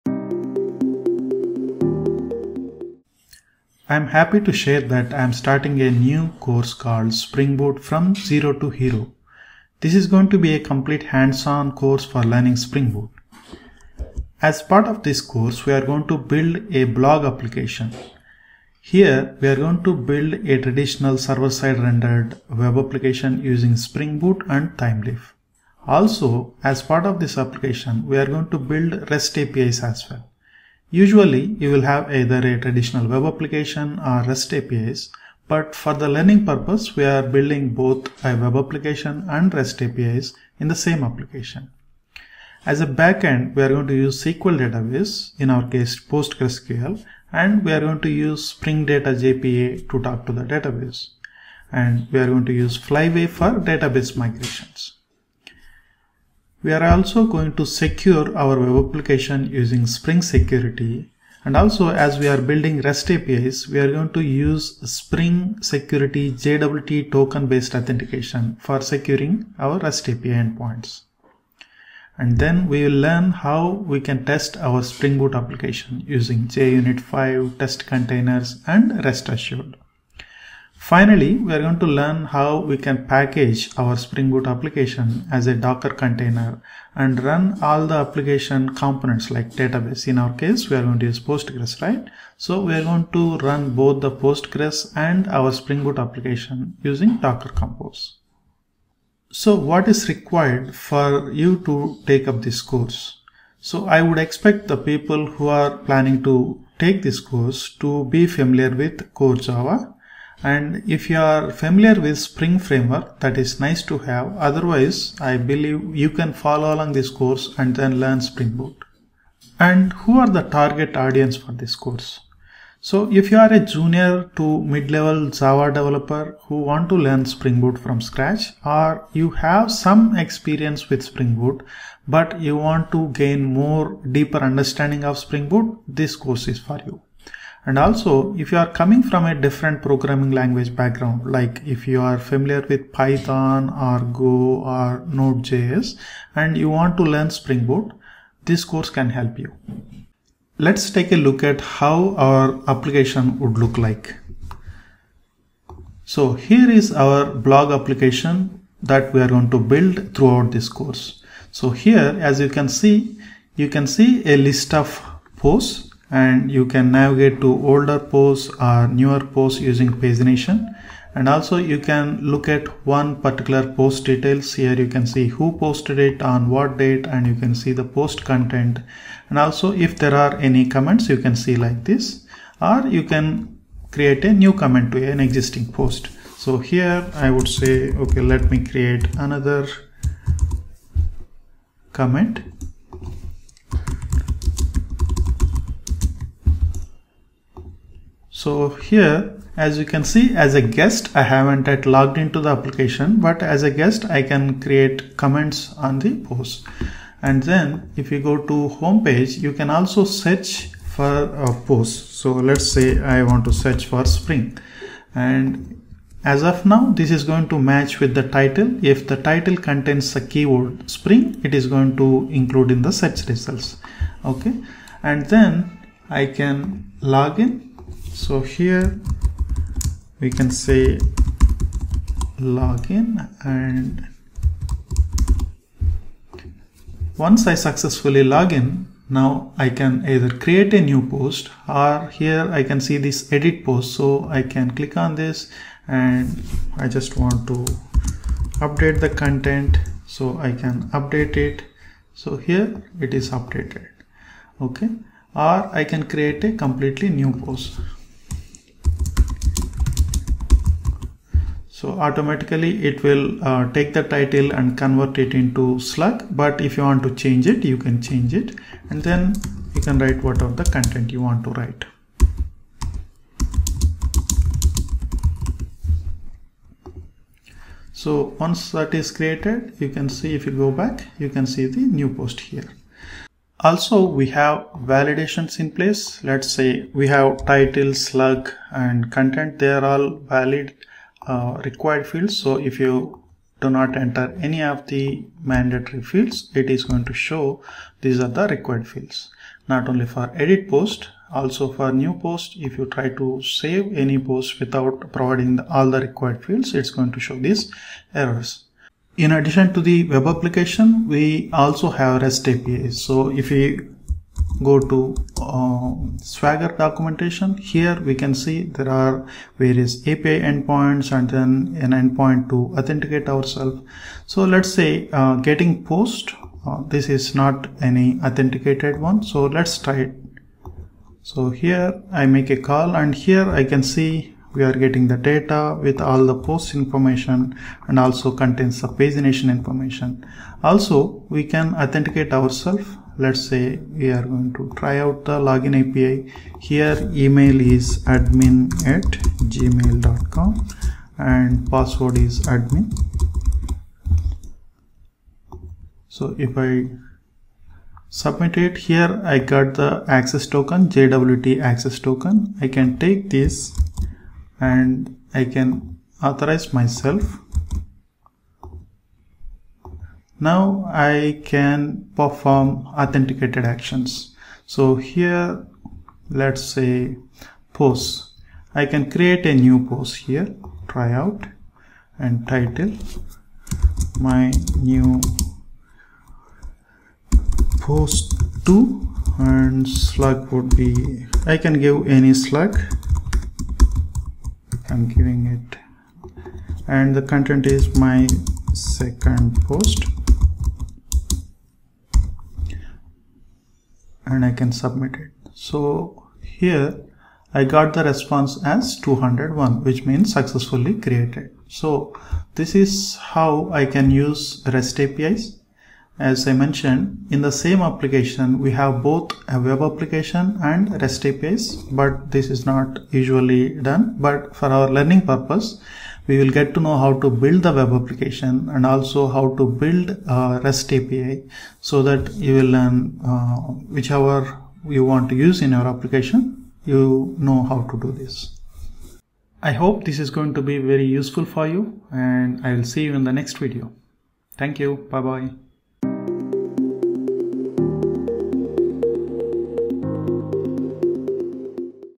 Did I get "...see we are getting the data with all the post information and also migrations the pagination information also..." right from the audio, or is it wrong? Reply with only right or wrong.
wrong.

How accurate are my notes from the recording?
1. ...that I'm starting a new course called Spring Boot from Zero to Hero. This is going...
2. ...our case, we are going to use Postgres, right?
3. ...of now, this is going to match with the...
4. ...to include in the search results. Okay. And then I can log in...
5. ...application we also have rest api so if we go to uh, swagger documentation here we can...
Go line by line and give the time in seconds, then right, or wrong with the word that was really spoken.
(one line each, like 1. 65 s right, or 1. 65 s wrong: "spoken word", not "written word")
1. 4 s right
2. 90 s right
3. 216 s right
4. 221 s right
5. 310 s right.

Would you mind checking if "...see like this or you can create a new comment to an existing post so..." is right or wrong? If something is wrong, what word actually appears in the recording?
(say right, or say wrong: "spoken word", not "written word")
right.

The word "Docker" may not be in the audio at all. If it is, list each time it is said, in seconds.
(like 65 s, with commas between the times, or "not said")
85 s, 97 s.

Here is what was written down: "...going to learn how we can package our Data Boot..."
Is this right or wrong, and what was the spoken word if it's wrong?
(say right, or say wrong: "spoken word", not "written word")
wrong: "Spring", not "Data".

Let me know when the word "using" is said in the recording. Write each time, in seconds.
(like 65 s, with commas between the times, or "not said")
23 s, 59 s, 76 s, 96 s, 169 s.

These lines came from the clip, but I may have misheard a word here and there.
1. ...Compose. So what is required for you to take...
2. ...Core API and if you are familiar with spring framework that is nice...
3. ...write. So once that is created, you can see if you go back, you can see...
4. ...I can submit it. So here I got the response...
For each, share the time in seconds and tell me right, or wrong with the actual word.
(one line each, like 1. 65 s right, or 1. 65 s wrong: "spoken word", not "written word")
1. 97 s right
2. 109 s wrong: "Java", not "API"
3. 271 s right
4. 404 s right.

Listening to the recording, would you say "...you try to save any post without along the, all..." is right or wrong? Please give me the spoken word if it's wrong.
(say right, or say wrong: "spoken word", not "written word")
wrong: "providing", not "along".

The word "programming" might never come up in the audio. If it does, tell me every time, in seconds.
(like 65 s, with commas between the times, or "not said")
139 s.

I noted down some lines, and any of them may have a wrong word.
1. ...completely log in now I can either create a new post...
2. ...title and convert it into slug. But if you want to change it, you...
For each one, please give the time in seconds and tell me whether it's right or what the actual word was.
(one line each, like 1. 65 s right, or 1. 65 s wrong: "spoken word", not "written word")
1. 237 s wrong: "successfully", not "completely"
2. 264 s right.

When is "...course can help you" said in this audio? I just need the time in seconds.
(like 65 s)
148 s.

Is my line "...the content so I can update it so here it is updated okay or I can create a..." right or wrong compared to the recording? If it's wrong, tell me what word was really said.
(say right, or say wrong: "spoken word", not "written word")
right.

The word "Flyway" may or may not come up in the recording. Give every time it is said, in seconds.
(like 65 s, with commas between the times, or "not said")
52 s.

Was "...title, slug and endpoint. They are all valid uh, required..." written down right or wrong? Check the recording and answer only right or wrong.
wrong.